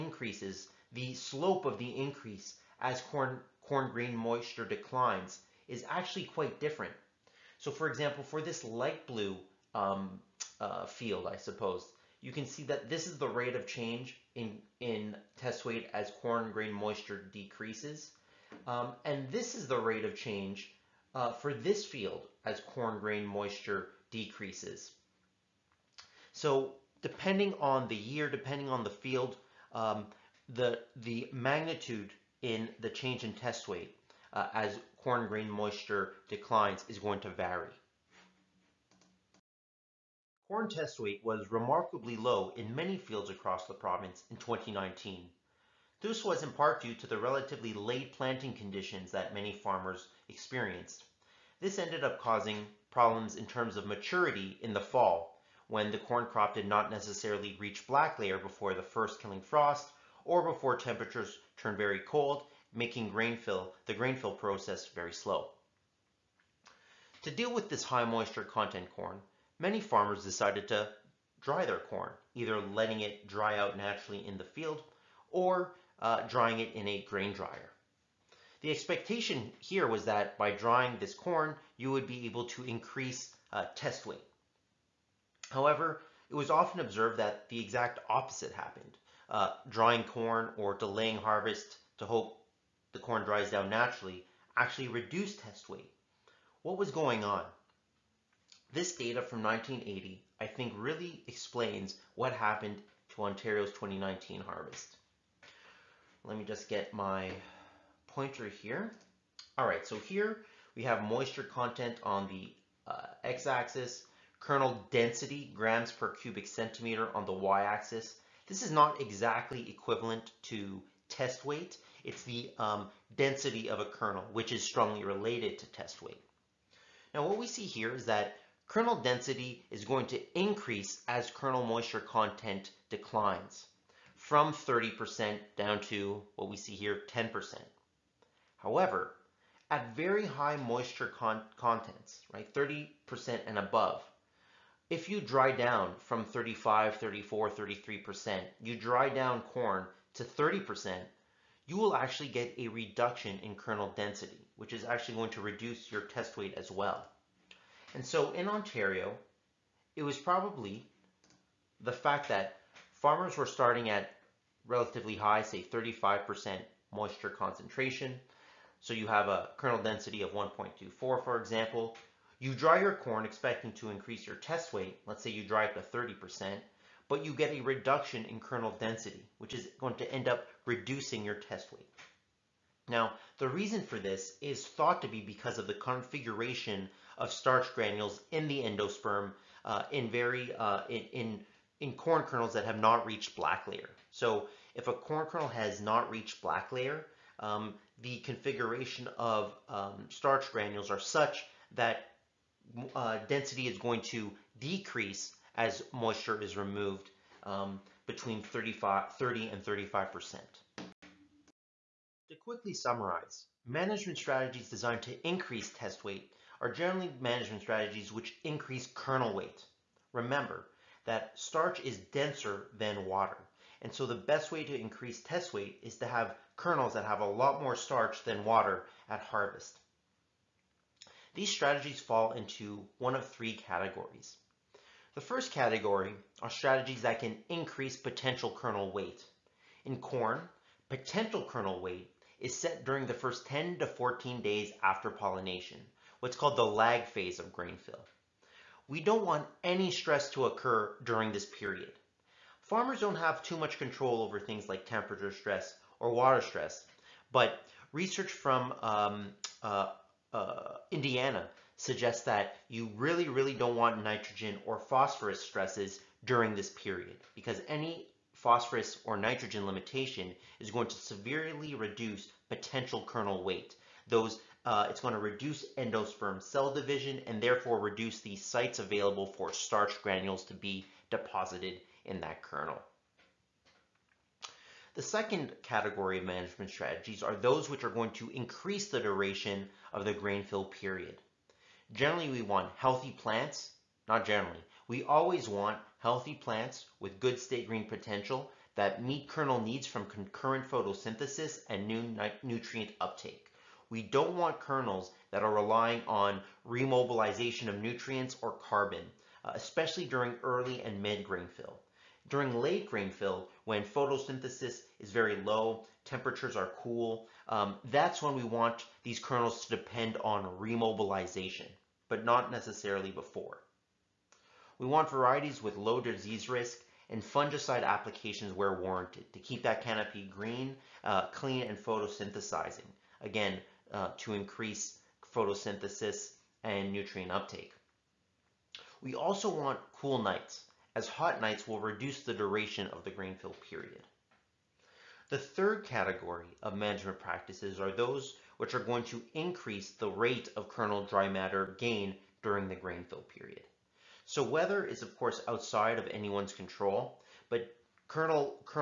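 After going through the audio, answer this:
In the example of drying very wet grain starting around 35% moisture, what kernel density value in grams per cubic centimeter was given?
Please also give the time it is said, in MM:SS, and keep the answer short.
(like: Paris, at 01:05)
1.24, at 02:50.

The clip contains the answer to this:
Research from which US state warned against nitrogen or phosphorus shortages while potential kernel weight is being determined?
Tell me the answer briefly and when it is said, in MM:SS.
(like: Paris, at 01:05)
Indiana, at 04:20.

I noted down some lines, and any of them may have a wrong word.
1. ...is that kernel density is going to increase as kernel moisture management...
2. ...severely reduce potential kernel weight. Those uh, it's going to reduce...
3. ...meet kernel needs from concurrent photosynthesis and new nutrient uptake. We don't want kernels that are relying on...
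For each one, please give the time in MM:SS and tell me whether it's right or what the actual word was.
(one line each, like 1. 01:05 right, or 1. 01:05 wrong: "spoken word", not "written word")
1. 02:07 wrong: "content", not "management"
2. 04:30 right
3. 04:59 right.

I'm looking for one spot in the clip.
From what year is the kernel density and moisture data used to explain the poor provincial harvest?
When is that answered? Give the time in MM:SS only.
01:39.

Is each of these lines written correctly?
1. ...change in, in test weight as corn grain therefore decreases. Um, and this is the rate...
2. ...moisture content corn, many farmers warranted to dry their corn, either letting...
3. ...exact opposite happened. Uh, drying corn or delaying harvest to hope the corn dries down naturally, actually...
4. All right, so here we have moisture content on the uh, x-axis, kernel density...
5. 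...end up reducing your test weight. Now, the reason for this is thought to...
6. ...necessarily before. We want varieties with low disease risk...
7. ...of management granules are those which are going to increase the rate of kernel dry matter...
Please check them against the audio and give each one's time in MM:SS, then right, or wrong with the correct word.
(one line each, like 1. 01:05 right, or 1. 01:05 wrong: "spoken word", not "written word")
1. 00:13 wrong: "moisture", not "therefore"
2. 01:08 wrong: "decided", not "warranted"
3. 01:27 right
4. 01:49 right
5. 03:00 right
6. 05:22 right
7. 05:46 wrong: "practices", not "granules".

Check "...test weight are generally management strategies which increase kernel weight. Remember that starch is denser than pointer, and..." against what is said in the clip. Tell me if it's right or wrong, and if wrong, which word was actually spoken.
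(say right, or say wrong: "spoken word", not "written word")
wrong: "water", not "pointer".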